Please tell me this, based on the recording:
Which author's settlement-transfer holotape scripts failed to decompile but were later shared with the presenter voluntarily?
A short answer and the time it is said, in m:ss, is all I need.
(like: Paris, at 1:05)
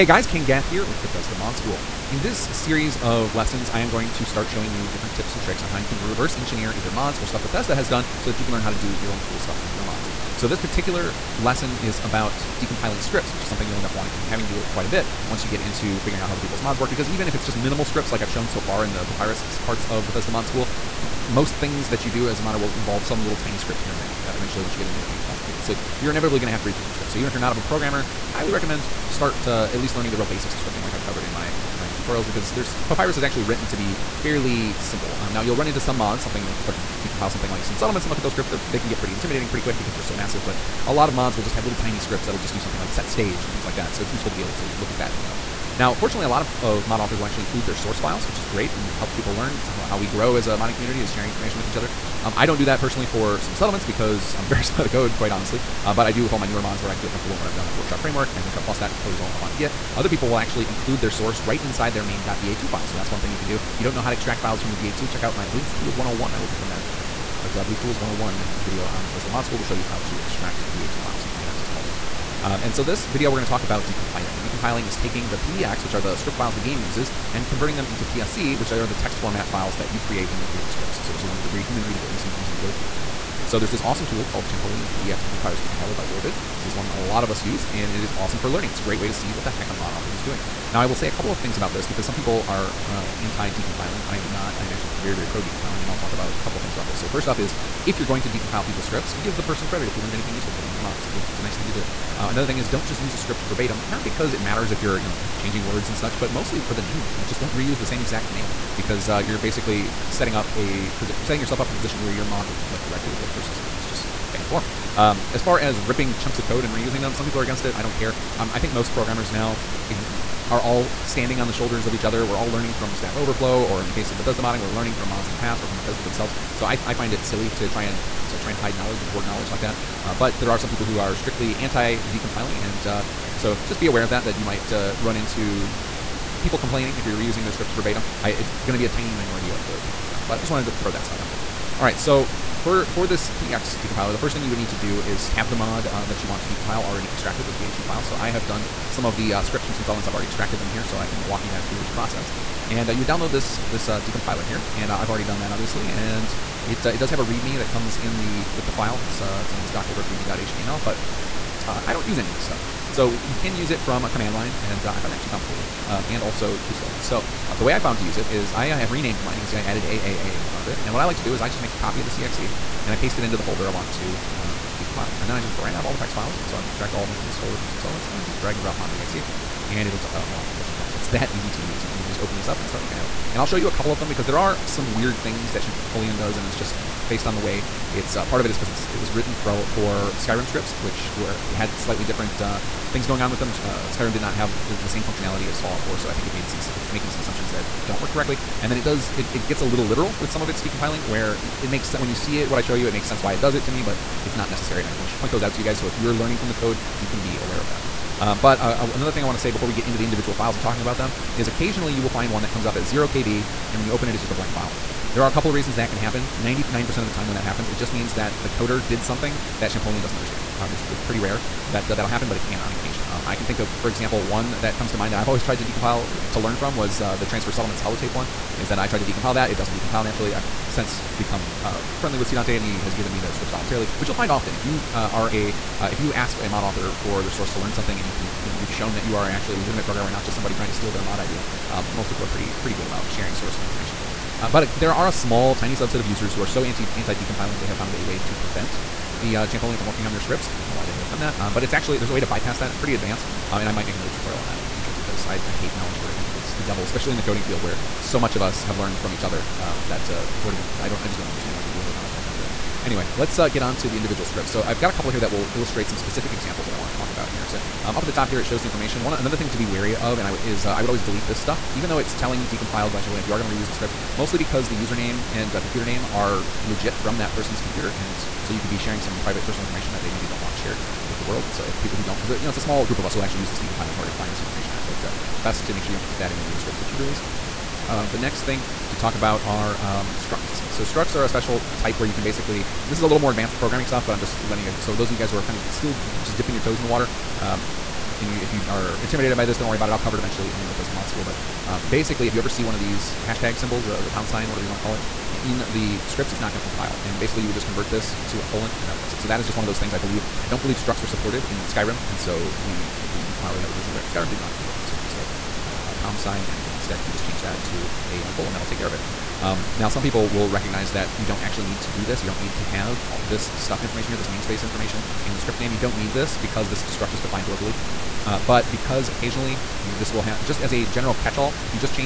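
Sidante, at 3:52.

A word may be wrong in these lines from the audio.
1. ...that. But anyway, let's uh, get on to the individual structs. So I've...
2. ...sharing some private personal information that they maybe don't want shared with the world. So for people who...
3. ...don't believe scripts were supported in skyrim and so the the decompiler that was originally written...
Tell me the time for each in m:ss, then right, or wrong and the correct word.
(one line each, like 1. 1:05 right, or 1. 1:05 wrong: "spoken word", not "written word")
1. 4:22 wrong: "scripts", not "structs"
2. 4:38 right
3. 5:10 wrong: "structs", not "scripts".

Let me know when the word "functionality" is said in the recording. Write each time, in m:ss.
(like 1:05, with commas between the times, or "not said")
3:15.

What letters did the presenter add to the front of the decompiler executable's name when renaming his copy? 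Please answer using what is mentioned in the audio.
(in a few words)
AAA.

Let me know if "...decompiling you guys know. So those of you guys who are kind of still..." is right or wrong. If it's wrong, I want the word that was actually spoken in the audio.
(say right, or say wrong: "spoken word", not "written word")
wrong: "letting", not "decompiling".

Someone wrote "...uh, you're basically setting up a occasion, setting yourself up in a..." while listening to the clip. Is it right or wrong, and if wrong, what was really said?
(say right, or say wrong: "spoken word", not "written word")
wrong: "position", not "occasion".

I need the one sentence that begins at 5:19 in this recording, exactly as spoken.
Um, now, some people will recognize that you don't actually need to do this.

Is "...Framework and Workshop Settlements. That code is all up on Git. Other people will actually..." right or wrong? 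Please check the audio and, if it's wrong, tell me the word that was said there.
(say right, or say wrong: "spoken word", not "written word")
wrong: "Plus", not "Settlements".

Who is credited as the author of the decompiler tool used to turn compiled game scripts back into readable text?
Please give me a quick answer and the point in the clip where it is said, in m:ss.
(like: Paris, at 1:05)
Orvid, at 1:26.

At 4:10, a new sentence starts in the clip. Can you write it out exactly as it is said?
I don't know why they have done that, um, but it's actually there's a way to bypass that.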